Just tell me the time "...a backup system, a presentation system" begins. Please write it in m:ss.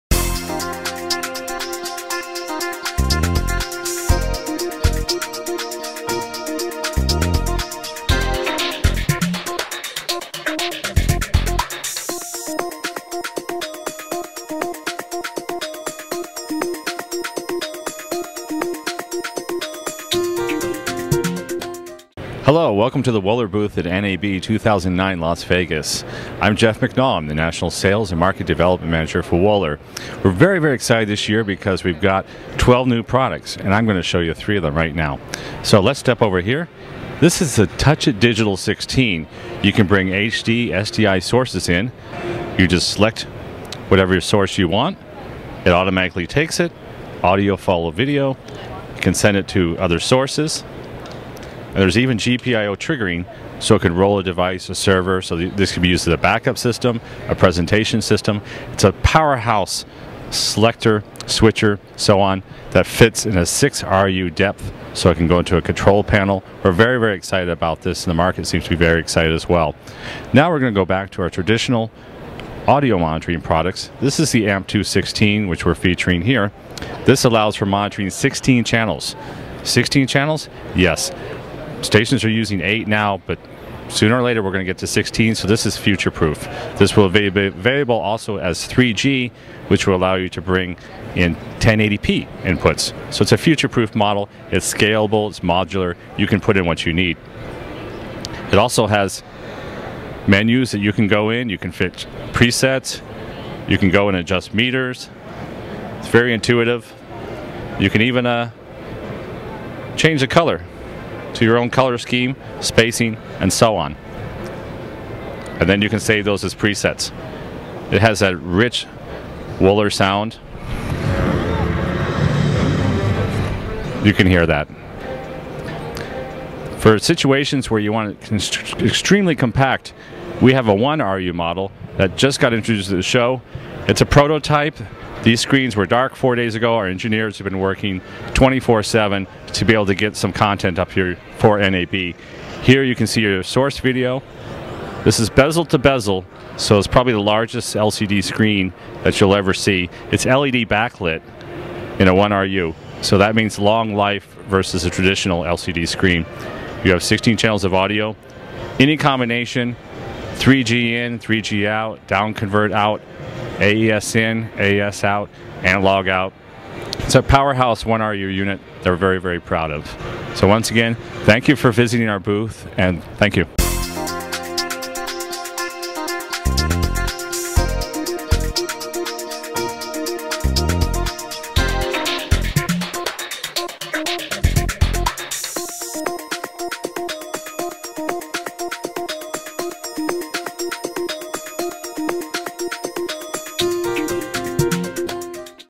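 0:56.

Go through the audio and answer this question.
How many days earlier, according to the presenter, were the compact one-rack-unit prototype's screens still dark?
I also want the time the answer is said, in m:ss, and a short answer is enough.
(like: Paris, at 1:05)
4, at 2:16.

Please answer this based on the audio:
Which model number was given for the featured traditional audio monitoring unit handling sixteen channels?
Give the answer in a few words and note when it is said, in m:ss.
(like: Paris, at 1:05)
AMP216, at 1:14.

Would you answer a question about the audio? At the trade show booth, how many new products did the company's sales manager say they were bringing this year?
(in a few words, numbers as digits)
12.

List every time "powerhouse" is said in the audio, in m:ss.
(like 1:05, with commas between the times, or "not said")
0:58, 2:47.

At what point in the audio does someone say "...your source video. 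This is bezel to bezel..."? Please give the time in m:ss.
2:23.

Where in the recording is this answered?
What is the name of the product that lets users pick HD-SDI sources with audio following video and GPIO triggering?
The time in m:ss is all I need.
0:37.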